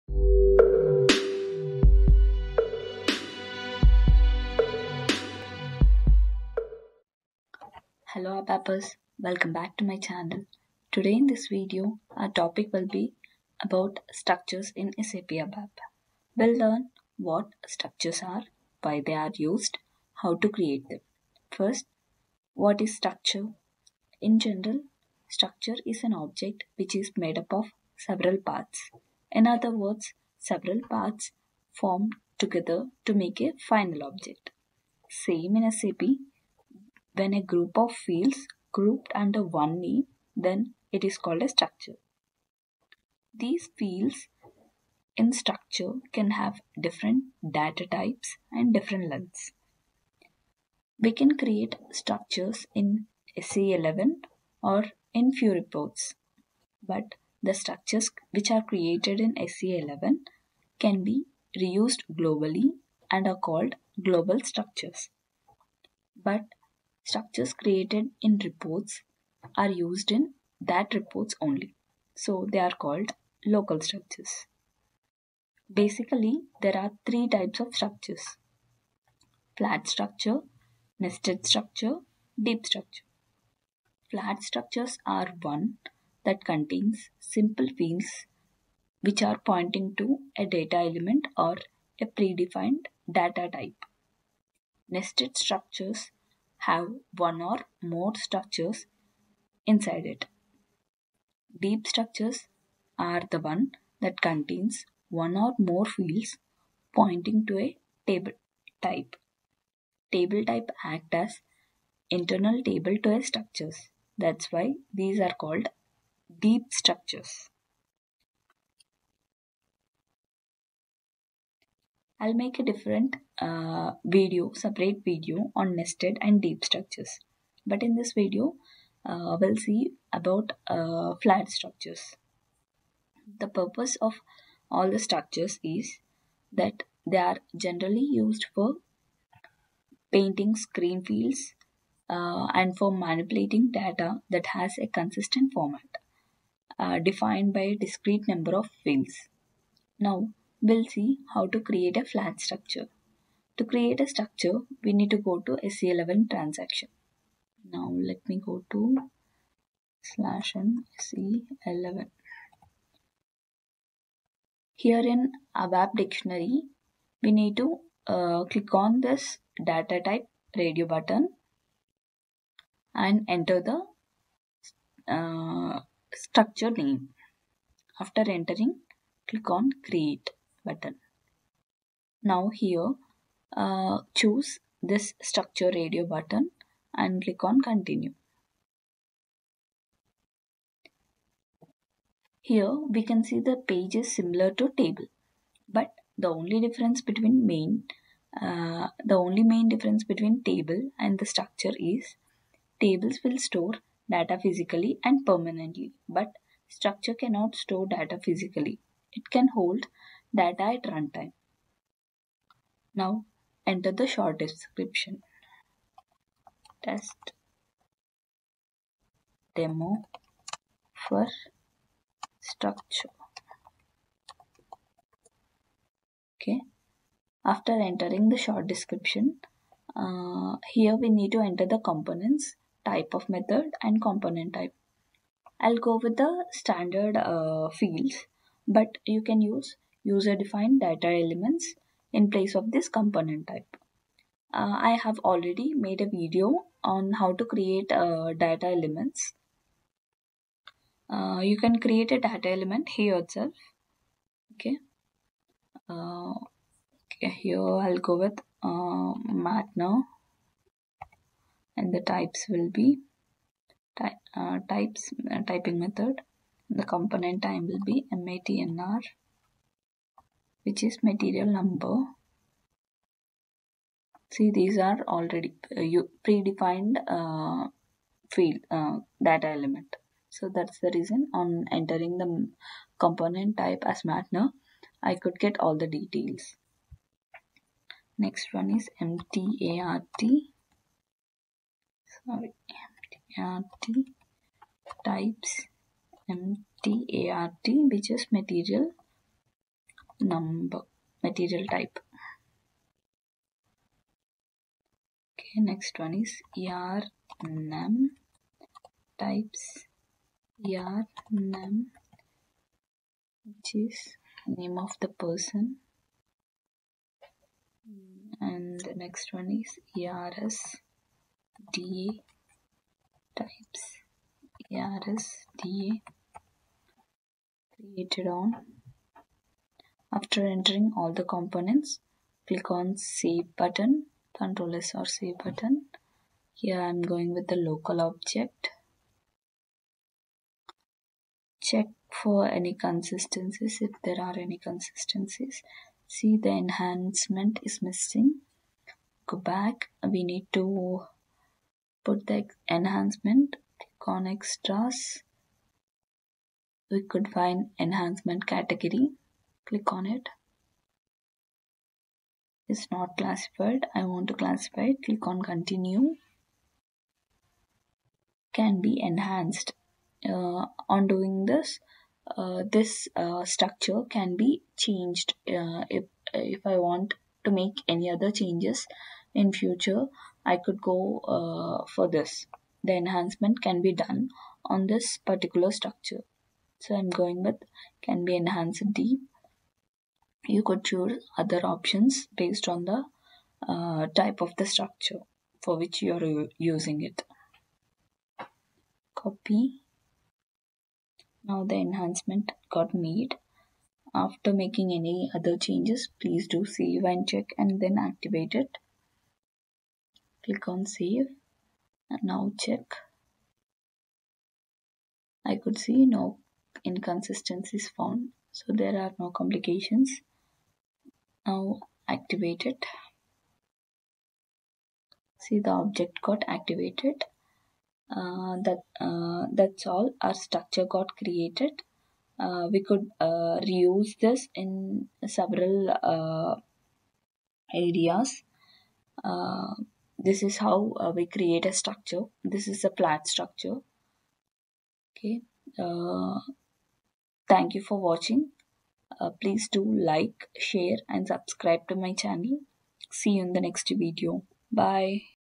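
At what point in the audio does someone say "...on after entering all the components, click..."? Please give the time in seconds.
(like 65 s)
328 s.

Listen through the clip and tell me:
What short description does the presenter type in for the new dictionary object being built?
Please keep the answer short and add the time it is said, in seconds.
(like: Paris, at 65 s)
Test demo for structure, at 216 s.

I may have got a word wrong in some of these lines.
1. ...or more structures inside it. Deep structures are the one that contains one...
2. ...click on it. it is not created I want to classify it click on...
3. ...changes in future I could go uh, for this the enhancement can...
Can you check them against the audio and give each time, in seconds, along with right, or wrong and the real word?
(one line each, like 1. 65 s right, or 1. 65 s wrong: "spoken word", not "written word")
1. 97 s right
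2. 359 s wrong: "classified", not "created"
3. 378 s right.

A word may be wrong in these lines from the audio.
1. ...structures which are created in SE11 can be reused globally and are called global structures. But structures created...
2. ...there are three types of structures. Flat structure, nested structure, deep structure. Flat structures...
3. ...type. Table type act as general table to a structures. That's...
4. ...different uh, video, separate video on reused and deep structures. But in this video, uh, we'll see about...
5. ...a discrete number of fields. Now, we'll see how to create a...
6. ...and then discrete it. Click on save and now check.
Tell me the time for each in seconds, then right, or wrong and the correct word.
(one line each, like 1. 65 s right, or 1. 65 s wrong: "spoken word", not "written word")
1. 57 s right
2. 76 s right
3. 108 s wrong: "internal", not "general"
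4. 122 s wrong: "nested", not "reused"
5. 147 s right
6. 407 s wrong: "activate", not "discrete".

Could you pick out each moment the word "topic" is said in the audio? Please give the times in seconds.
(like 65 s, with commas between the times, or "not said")
12 s.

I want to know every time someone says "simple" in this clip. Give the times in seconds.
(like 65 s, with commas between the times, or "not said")
87 s.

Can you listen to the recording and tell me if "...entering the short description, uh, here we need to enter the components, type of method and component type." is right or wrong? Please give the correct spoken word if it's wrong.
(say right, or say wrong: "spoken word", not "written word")
right.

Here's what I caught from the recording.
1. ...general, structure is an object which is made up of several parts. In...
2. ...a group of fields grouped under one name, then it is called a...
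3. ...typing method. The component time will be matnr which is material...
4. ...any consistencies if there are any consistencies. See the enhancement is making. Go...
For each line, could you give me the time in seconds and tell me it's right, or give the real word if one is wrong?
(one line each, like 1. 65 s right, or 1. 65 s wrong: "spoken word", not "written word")
1. 24 s right
2. 37 s right
3. 265 s right
4. 342 s wrong: "missing", not "making".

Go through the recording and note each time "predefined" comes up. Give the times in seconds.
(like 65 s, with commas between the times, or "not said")
92 s, 276 s.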